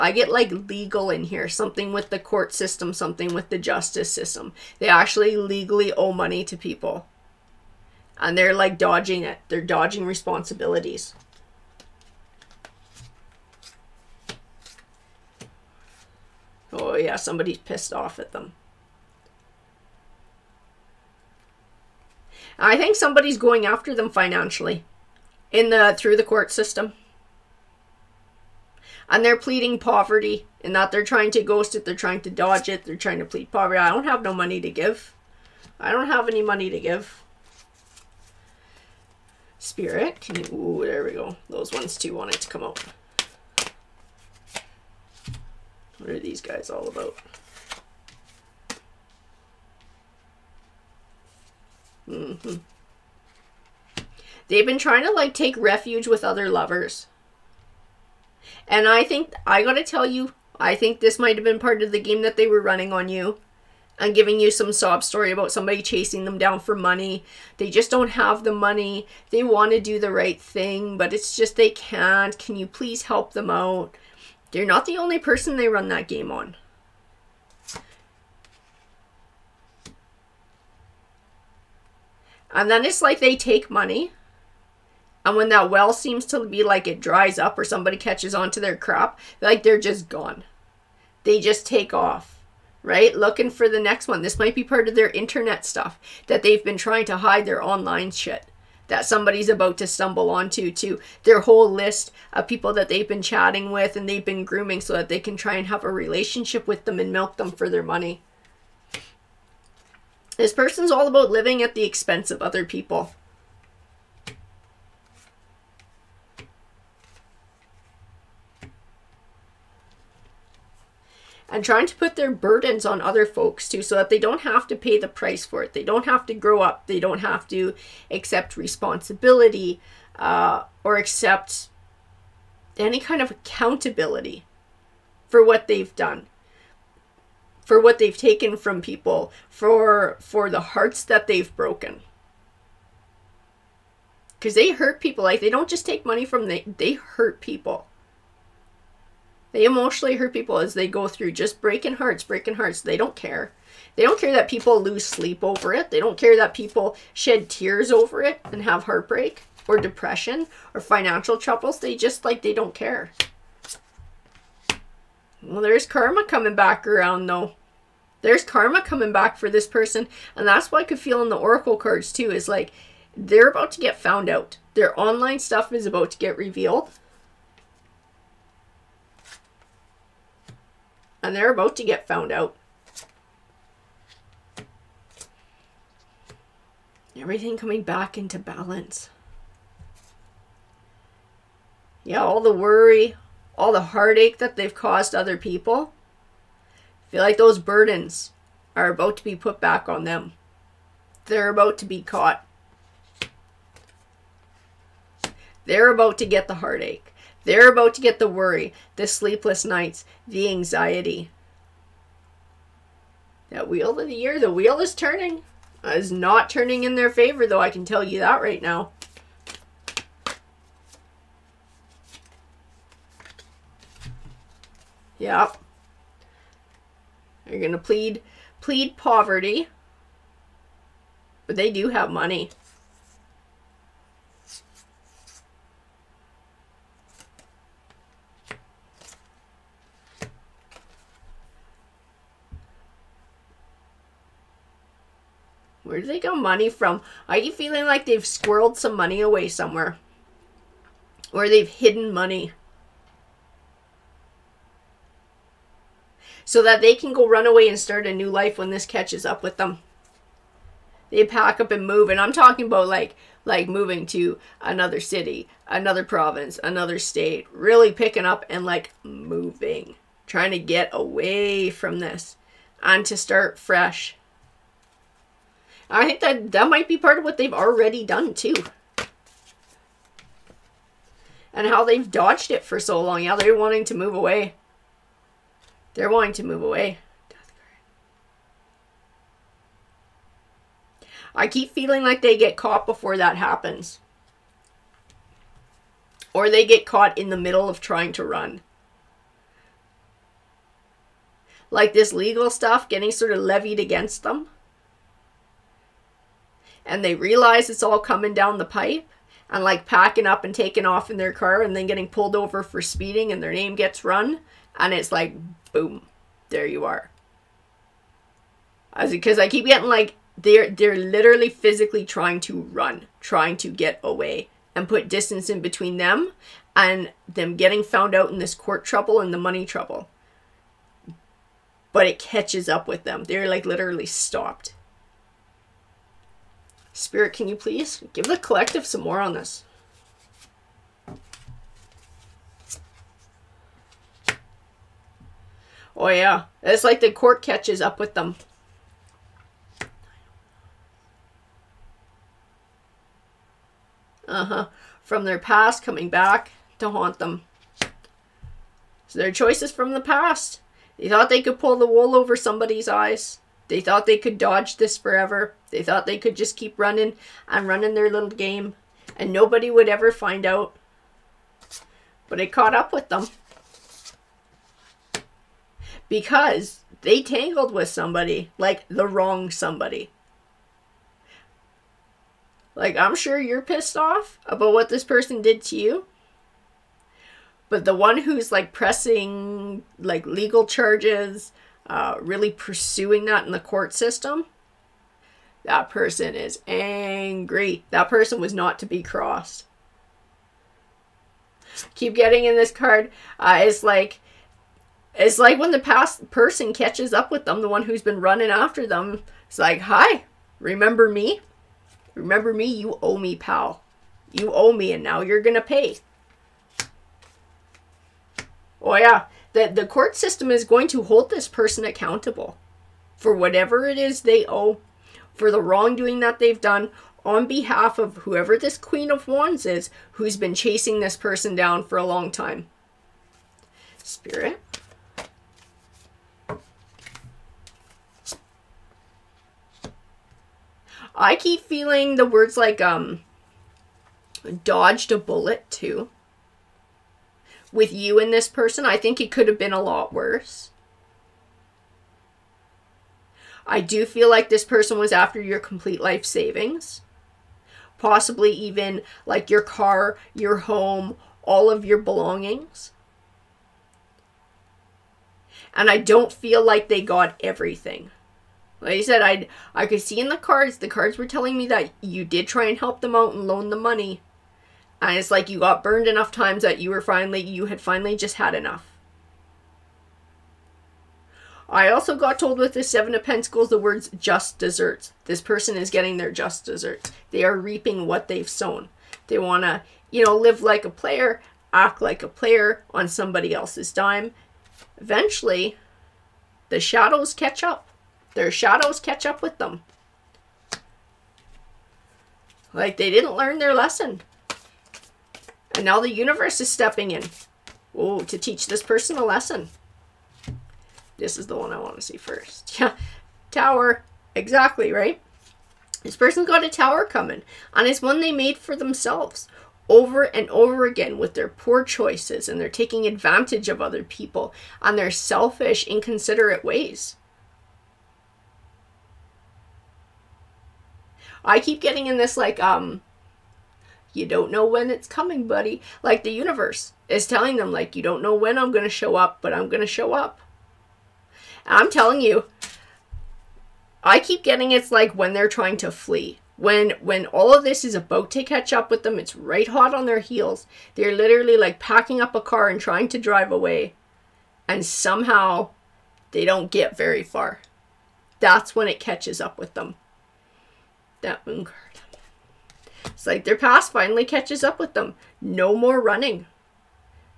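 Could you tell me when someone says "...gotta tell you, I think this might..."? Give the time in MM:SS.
00:59.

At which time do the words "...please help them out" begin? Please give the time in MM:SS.
01:12.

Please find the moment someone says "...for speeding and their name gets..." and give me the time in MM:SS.
05:12.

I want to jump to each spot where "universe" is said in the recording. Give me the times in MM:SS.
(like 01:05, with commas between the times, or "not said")
08:26, 08:56.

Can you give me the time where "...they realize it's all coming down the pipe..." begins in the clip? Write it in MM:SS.
05:07.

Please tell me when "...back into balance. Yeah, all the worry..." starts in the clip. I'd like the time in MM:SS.
03:07.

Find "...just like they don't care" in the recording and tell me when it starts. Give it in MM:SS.
02:41.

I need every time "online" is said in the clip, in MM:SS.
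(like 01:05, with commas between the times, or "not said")
01:37, 02:54.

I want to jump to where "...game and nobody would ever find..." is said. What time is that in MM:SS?
06:08.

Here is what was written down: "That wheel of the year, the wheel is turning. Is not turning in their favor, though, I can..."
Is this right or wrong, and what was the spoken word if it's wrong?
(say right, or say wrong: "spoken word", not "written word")
right.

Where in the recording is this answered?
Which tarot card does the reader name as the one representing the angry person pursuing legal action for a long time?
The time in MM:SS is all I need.
07:08.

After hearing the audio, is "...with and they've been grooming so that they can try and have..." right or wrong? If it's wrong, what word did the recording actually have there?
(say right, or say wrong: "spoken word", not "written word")
right.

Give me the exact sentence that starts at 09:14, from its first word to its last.
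And somehow they don't get very far.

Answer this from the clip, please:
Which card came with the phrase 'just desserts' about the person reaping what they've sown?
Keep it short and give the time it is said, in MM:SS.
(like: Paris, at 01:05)
Seven of Pentacles, at 08:02.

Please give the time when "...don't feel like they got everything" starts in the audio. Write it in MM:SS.
07:45.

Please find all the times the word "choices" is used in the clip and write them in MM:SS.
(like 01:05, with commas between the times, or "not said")
05:59, 08:41.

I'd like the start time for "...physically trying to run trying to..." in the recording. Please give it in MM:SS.
05:21.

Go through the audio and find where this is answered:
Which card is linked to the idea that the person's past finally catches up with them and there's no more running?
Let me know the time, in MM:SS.
09:21.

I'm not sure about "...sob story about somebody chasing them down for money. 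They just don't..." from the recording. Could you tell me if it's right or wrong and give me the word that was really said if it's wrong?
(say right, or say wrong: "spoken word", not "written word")
right.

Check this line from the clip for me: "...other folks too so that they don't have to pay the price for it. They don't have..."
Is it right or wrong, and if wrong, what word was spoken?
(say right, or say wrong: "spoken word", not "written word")
right.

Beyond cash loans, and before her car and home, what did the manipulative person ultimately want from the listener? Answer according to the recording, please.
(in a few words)
complete life savings.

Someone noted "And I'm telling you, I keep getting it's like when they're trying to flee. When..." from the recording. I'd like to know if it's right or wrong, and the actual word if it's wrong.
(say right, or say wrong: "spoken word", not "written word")
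right.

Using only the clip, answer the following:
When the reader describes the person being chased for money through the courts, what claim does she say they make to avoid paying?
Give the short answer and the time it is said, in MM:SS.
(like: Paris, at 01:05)
pleading poverty, at 00:29.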